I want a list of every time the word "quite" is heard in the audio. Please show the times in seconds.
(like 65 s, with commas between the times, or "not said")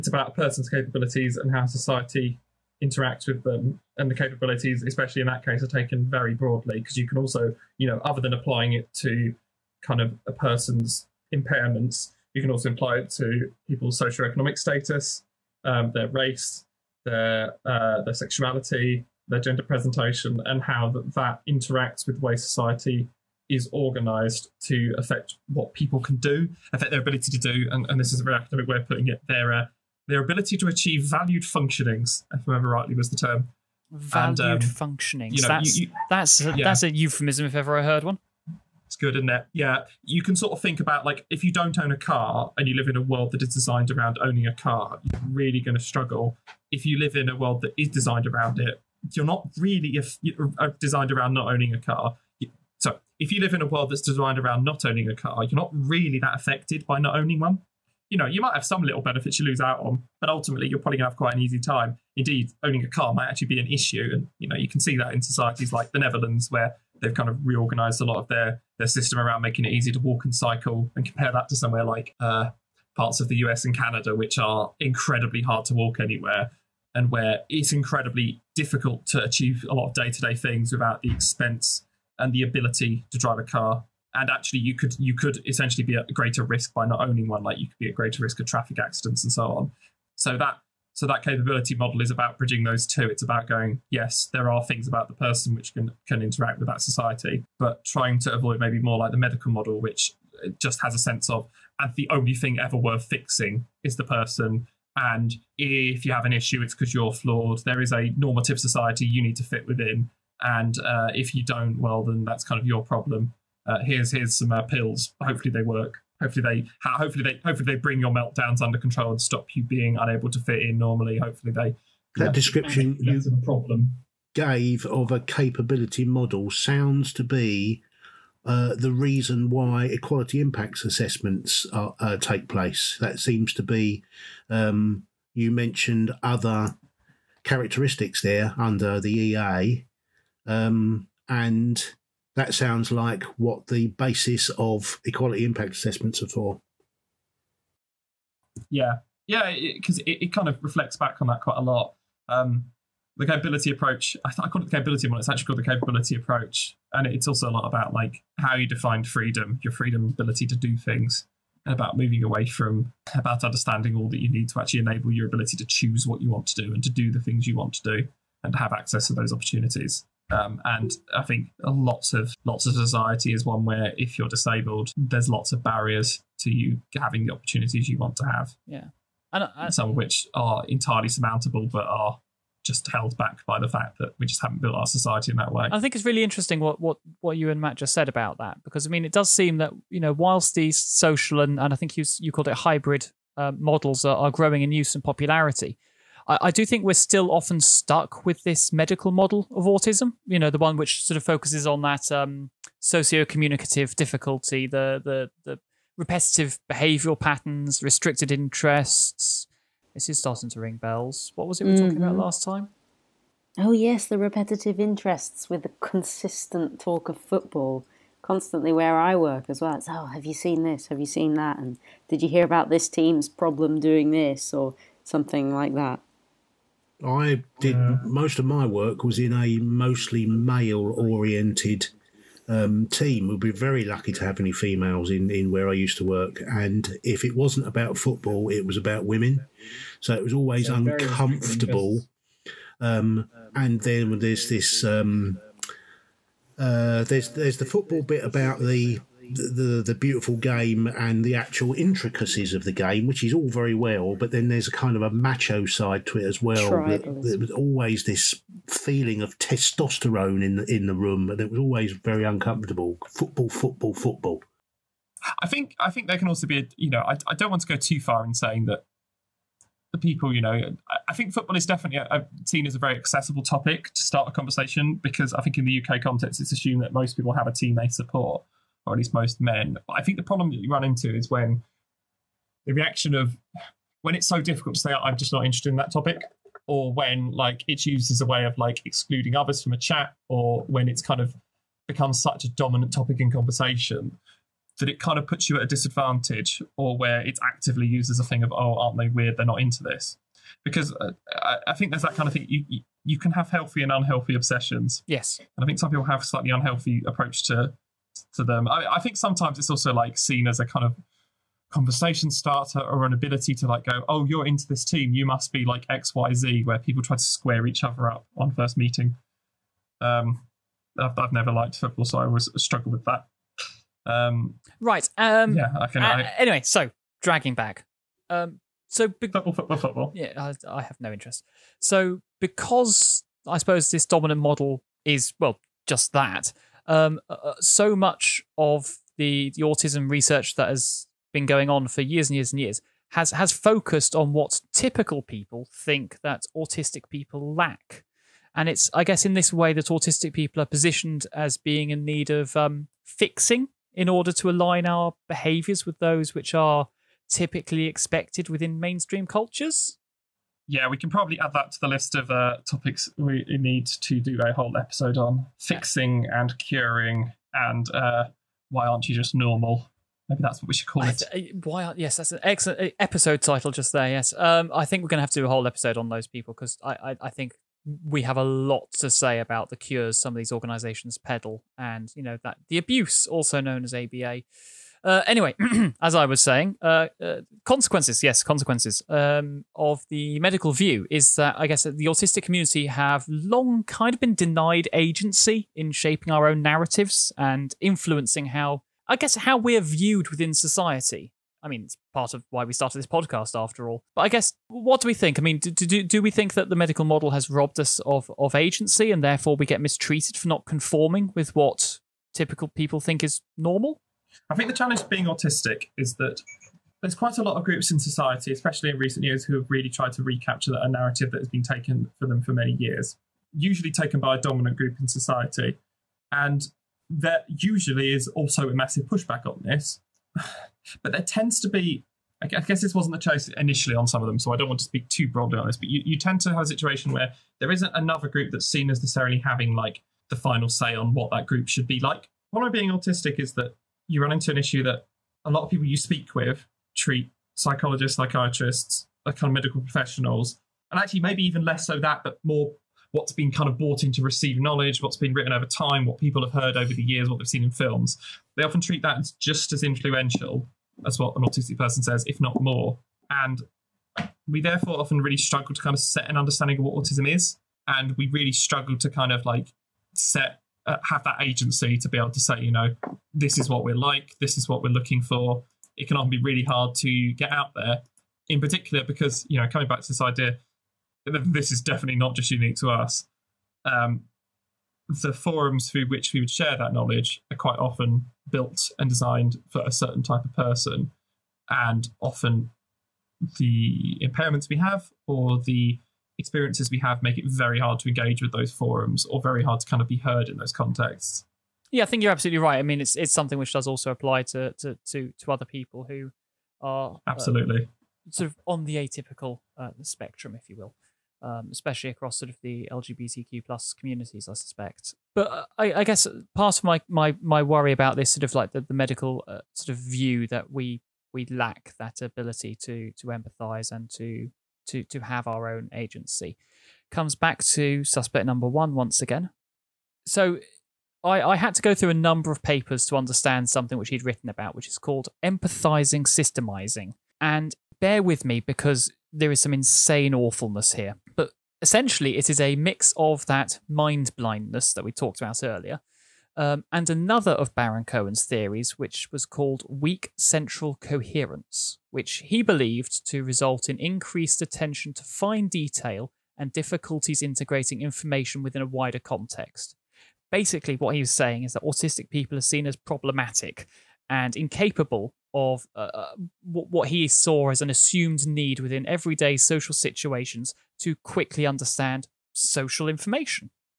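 61 s, 151 s, 417 s, 487 s.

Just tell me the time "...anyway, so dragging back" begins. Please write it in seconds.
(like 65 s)
326 s.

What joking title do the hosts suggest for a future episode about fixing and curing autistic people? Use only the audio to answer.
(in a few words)
Why aren't you just normal?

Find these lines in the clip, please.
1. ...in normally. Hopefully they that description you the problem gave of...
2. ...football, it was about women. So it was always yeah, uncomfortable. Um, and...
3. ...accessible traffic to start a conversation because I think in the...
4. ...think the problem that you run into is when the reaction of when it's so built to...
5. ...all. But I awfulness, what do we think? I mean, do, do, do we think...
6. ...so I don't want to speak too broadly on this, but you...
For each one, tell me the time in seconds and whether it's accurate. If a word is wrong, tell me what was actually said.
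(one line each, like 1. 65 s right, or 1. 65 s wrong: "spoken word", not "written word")
1. 120 s right
2. 237 s right
3. 272 s wrong: "topic", not "traffic"
4. 280 s wrong: "difficult", not "built"
5. 403 s wrong: "guess", not "awfulness"
6. 434 s right.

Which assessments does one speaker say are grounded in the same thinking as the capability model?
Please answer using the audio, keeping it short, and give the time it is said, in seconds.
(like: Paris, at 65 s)
equality impact assessments, at 129 s.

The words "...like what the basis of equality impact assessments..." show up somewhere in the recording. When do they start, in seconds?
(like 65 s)
142 s.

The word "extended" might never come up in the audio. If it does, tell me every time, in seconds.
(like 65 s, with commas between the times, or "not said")
not said.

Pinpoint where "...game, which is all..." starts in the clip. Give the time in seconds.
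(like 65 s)
252 s.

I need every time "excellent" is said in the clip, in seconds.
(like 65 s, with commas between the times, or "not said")
372 s.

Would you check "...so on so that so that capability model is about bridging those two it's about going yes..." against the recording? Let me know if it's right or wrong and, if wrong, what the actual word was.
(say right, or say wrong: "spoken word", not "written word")
right.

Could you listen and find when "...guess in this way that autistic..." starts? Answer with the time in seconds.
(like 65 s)
349 s.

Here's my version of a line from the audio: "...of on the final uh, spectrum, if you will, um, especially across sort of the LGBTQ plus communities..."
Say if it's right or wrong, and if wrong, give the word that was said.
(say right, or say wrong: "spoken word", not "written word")
wrong: "atypical", not "final".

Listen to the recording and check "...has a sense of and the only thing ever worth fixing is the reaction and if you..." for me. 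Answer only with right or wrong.
wrong.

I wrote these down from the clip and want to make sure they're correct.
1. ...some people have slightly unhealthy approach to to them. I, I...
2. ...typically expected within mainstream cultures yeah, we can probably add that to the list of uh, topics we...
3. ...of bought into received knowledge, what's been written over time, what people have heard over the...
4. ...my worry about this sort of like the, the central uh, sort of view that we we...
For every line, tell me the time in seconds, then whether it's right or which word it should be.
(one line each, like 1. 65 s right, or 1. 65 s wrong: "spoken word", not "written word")
1. 305 s right
2. 357 s right
3. 453 s right
4. 517 s wrong: "medical", not "central".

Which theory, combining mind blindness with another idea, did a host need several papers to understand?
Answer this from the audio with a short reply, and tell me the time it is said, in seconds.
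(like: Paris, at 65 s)
empathizing systemizing, at 535 s.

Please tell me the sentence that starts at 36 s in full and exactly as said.
that's a euphemism if ever I heard one.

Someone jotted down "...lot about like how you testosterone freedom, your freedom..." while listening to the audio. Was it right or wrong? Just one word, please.
wrong.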